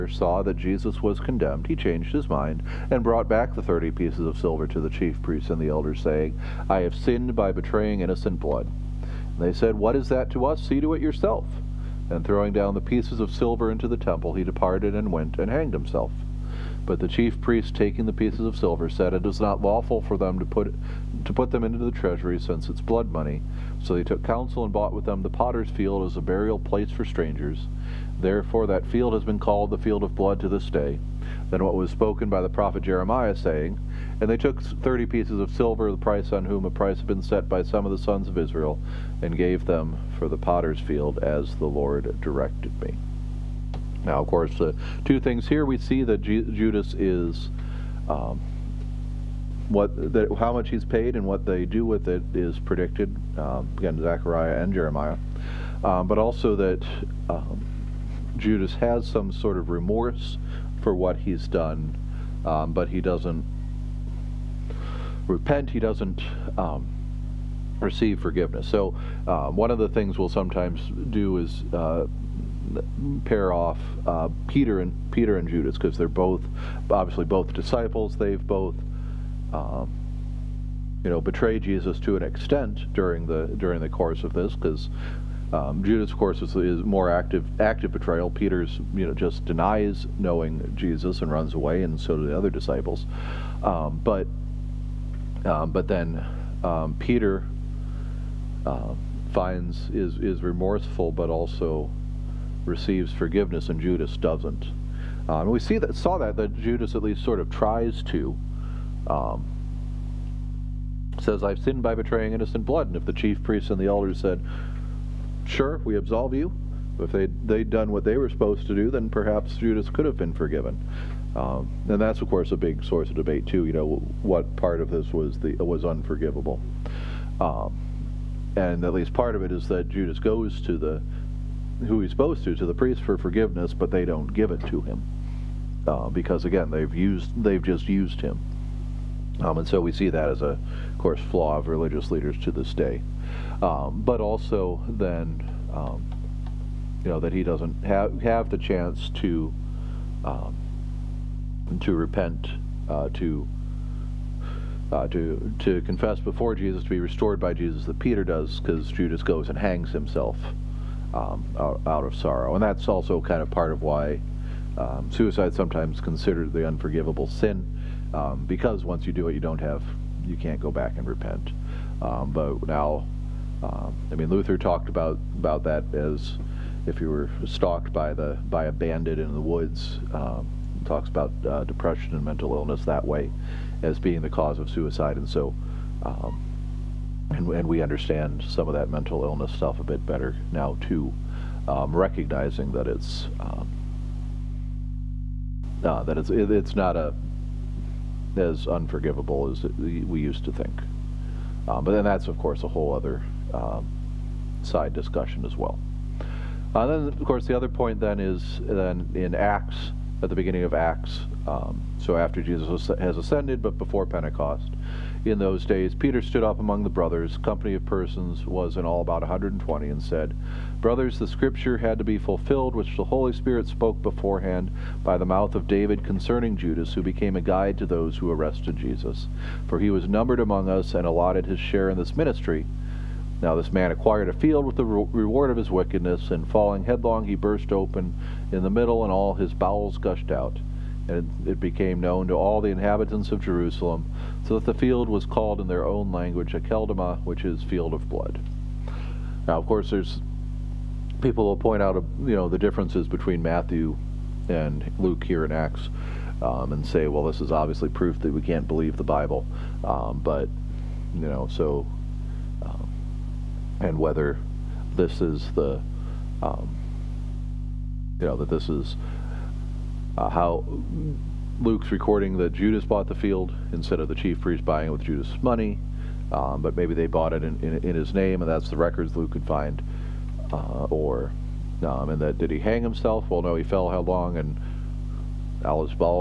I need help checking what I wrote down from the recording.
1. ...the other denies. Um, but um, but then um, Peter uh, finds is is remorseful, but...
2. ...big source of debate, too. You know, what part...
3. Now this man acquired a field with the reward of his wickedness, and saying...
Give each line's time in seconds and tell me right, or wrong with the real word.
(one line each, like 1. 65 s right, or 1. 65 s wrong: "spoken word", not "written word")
1. 92 s wrong: "disciples", not "denies"
2. 122 s right
3. 233 s wrong: "falling", not "saying".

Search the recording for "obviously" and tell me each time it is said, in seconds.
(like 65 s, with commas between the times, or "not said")
76 s, 257 s.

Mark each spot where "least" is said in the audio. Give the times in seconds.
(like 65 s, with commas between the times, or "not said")
107 s, 128 s.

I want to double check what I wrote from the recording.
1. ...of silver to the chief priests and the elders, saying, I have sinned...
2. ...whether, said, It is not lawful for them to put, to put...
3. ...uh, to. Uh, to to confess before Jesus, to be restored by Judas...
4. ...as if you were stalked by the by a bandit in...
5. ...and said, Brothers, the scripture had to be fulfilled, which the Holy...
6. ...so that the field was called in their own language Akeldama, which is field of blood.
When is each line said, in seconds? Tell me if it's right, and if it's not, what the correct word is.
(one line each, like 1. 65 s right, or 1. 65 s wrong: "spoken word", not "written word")
1. 4 s right
2. 18 s wrong: "silver", not "whether"
3. 152 s wrong: "Jesus", not "Judas"
4. 175 s right
5. 219 s right
6. 244 s right.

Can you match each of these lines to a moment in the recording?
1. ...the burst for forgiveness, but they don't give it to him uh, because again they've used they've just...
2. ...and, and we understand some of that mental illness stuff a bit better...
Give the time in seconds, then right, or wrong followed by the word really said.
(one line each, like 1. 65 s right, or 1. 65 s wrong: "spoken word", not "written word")
1. 132 s wrong: "priest", not "burst"
2. 187 s right.